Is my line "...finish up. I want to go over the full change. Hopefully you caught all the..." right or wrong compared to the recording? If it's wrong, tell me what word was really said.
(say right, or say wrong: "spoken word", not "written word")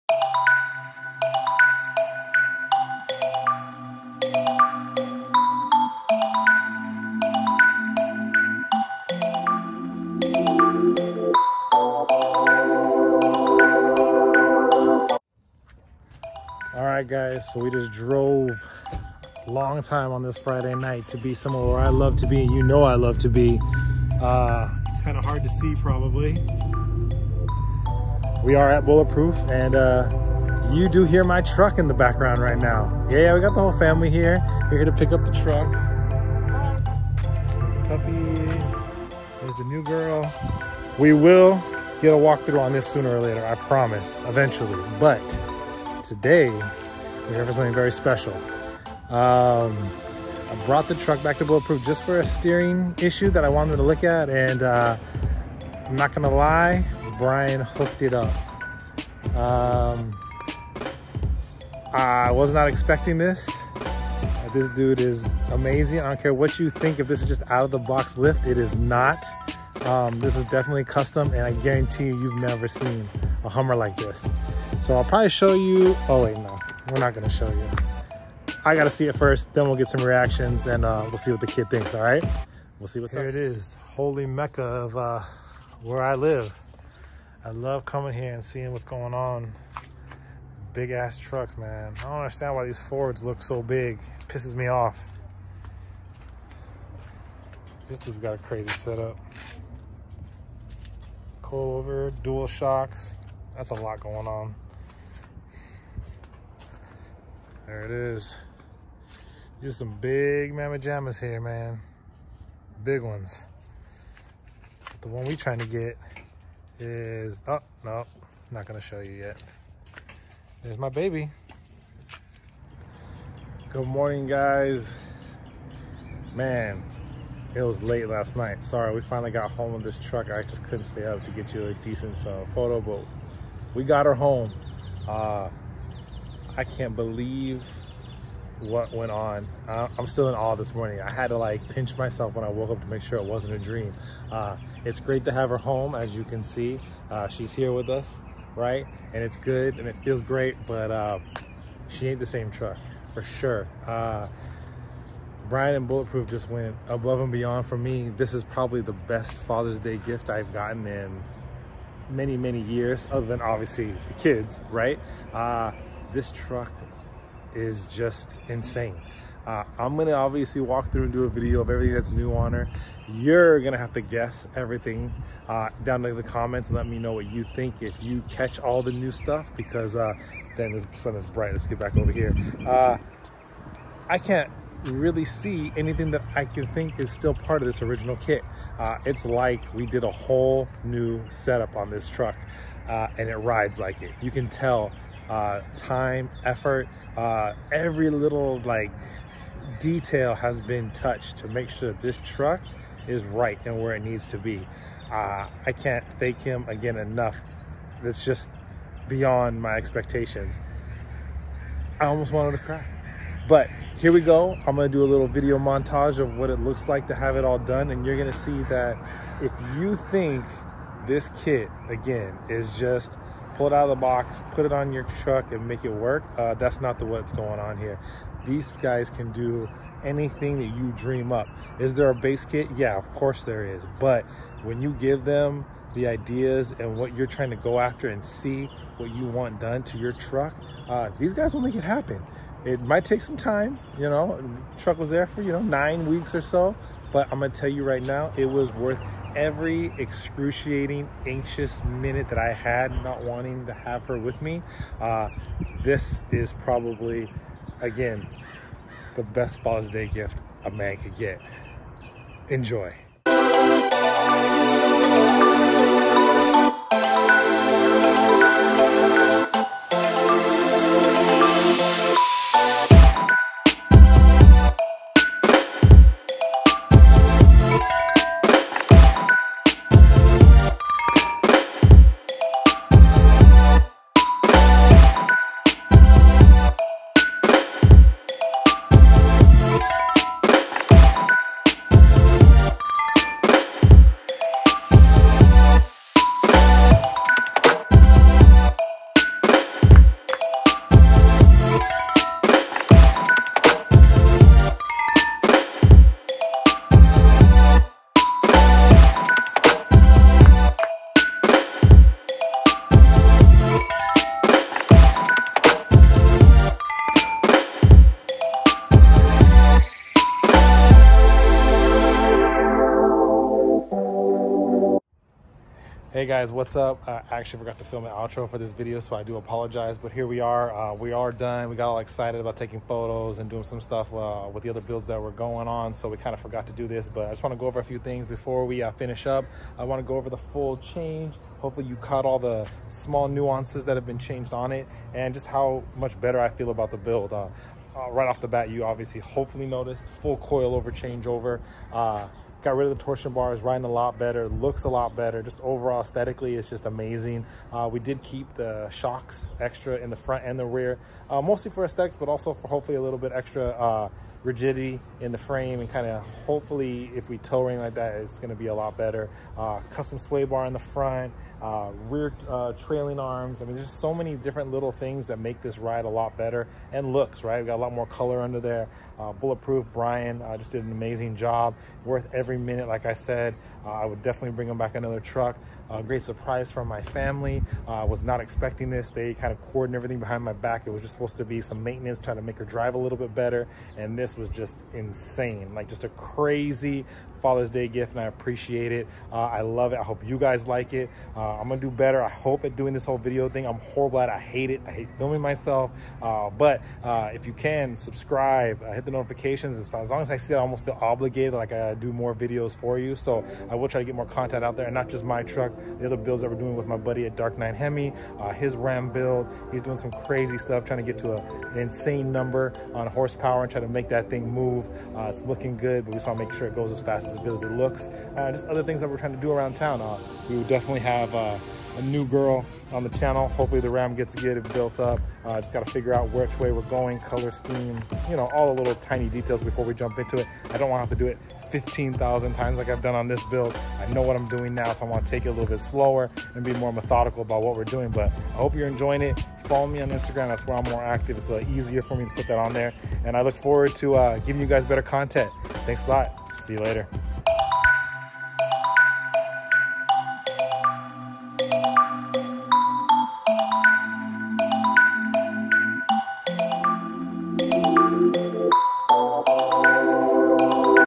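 right.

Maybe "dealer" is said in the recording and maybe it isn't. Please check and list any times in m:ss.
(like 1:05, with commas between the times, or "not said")
not said.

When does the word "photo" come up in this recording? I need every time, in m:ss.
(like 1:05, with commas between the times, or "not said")
2:12, 5:32.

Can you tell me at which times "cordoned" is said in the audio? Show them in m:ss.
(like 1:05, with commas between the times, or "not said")
6:29.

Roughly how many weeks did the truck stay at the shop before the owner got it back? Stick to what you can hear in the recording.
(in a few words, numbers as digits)
9.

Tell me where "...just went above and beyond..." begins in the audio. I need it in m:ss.
2:36.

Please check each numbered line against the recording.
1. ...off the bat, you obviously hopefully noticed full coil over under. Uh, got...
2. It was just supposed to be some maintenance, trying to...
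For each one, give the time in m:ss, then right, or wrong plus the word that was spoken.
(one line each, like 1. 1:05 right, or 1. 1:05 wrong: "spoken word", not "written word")
1. 5:48 wrong: "changeover", not "under"
2. 6:30 right.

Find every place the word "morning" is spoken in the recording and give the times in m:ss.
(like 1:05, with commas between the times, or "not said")
2:03, 2:20.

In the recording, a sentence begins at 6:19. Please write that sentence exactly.
Uh, bulletproof Brian uh, just did an amazing job.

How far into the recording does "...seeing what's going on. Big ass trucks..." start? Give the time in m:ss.
1:28.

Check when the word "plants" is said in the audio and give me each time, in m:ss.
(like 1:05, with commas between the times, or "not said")
not said.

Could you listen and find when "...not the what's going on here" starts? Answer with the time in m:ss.
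3:46.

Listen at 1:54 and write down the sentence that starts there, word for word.
the one we trying to get is, oh, no, not gonna show you yet.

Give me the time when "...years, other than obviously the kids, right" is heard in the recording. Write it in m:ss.
2:42.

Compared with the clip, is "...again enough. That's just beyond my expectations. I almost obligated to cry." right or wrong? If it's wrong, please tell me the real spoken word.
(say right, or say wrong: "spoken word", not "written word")
wrong: "wanted", not "obligated".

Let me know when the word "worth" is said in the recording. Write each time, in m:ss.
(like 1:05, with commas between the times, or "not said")
4:08, 6:22.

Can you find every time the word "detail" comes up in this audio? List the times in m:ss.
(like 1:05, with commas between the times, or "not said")
3:19, 7:19.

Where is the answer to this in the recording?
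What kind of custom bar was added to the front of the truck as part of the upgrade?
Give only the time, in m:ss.
6:09.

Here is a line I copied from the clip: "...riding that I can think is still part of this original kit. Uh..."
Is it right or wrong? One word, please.
wrong.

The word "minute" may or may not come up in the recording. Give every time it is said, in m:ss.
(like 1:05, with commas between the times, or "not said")
4:11, 6:22.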